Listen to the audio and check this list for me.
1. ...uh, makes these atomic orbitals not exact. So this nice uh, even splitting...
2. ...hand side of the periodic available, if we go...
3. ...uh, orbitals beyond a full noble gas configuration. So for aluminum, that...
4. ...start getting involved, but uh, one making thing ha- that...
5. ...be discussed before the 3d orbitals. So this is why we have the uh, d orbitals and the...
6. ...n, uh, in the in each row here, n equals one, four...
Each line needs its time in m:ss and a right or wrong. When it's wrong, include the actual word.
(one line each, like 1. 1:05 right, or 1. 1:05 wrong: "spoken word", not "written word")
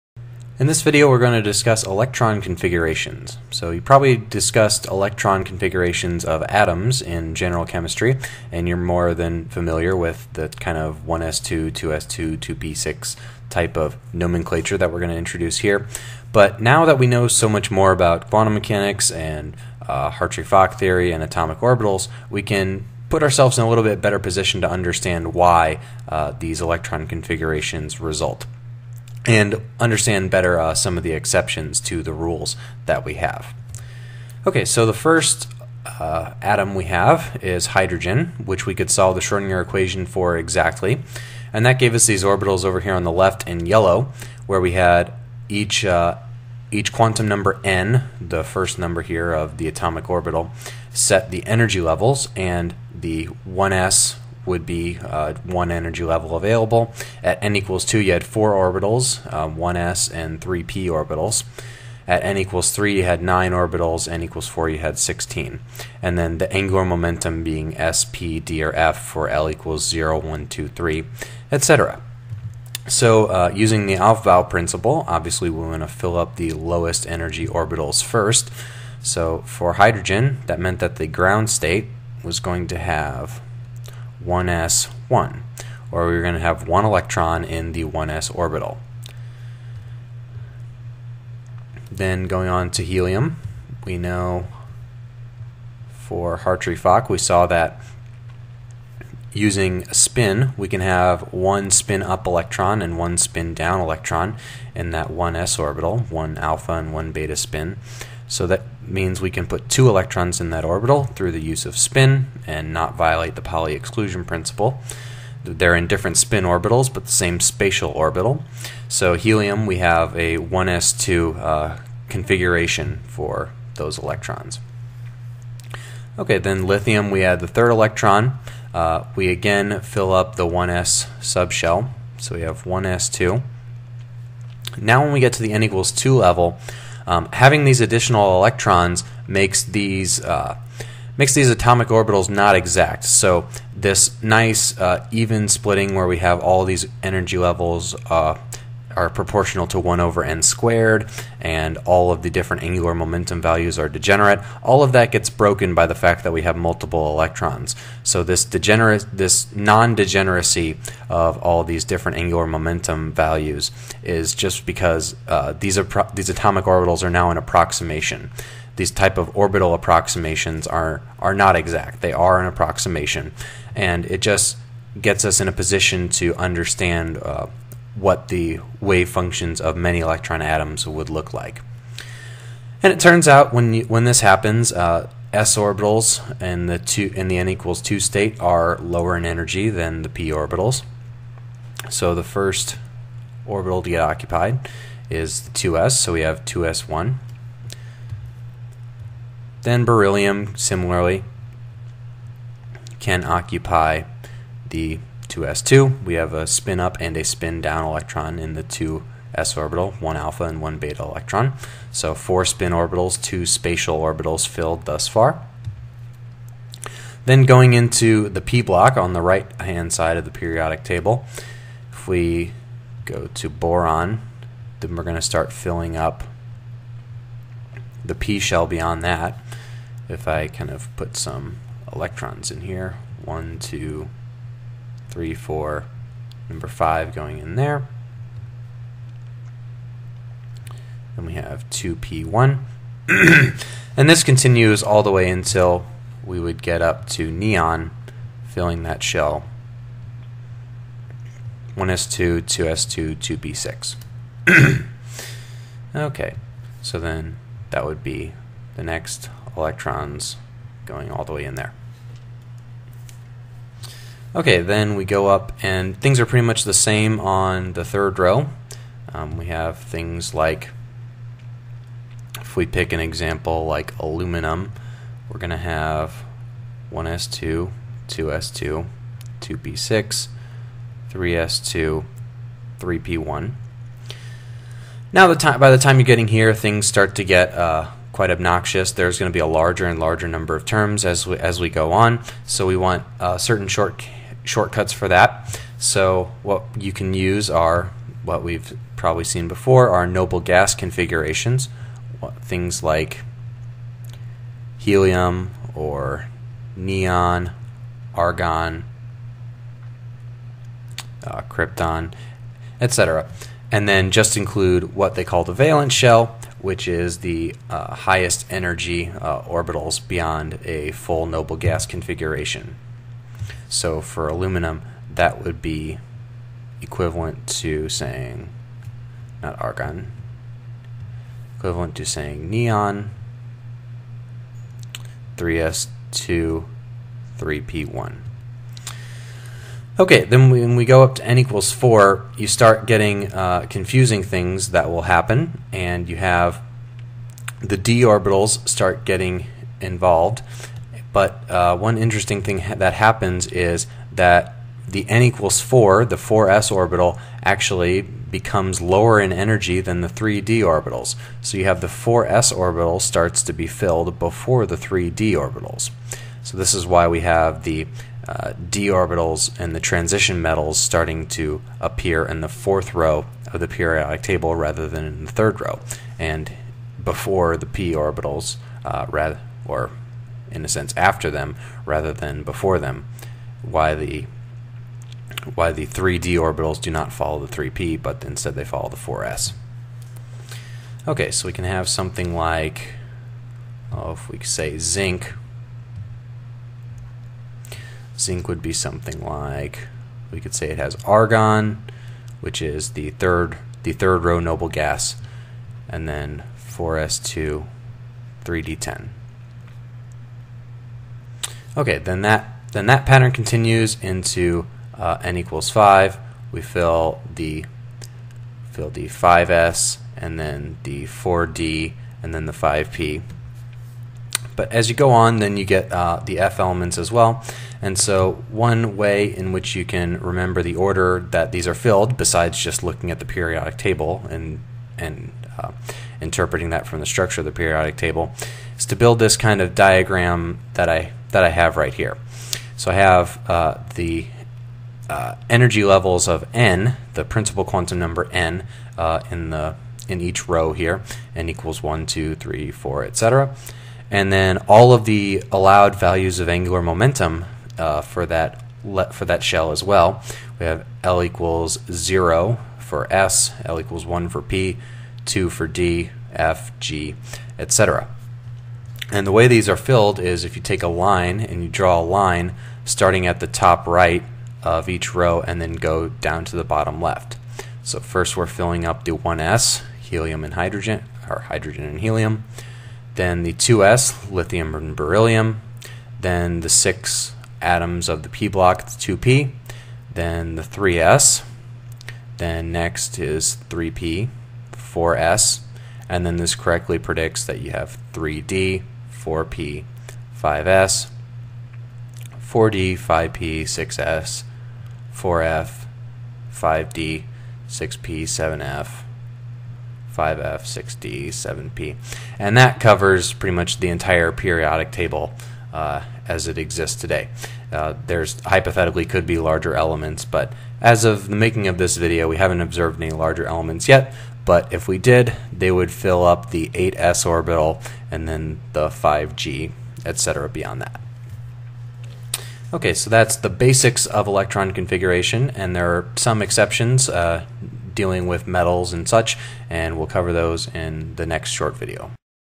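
1. 2:20 right
2. 3:39 wrong: "table", not "available"
3. 5:19 right
4. 5:48 wrong: "interesting", not "making"
5. 6:03 wrong: "filled", not "discussed"
6. 7:28 wrong: "two", not "four".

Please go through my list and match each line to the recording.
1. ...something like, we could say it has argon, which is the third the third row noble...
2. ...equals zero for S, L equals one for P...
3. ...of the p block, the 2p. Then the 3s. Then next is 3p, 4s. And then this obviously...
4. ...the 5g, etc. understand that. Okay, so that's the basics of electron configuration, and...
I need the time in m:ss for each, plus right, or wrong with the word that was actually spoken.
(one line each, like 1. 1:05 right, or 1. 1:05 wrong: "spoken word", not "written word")
1. 6:38 right
2. 7:41 right
3. 8:08 wrong: "correctly", not "obviously"
4. 8:48 wrong: "beyond", not "understand".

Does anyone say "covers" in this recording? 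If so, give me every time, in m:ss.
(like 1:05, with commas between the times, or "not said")
8:32, 9:00.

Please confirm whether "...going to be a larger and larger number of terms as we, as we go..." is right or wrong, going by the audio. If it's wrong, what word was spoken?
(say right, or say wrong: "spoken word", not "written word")
right.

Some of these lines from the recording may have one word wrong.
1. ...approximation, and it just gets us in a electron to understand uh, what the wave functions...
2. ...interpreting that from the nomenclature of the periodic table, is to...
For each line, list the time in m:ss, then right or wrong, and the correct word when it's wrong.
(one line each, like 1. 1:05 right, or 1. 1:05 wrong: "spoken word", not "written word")
1. 2:52 wrong: "position", not "electron"
2. 7:16 wrong: "structure", not "nomenclature".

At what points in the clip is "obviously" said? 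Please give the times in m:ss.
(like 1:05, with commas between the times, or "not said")
1:15.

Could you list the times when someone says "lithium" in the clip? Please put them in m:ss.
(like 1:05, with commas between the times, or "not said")
2:06, 8:04.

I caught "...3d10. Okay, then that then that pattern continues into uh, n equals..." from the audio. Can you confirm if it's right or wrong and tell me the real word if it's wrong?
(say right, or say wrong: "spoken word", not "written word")
right.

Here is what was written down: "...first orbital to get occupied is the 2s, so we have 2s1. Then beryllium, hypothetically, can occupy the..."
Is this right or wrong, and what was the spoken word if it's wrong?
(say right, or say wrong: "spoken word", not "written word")
wrong: "similarly", not "hypothetically".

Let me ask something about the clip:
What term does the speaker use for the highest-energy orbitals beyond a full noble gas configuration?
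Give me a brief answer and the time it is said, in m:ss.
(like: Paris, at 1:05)
Valence shell, at 5:15.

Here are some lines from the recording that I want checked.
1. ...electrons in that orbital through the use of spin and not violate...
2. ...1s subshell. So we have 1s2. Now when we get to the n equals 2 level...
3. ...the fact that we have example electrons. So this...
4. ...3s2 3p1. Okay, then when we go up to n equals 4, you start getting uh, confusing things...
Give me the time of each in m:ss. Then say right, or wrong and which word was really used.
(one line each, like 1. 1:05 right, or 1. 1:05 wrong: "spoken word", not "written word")
1. 1:49 right
2. 2:10 right
3. 2:35 wrong: "multiple", not "example"
4. 5:35 right.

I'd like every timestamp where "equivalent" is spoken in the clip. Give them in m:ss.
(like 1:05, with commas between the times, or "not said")
5:26, 5:31.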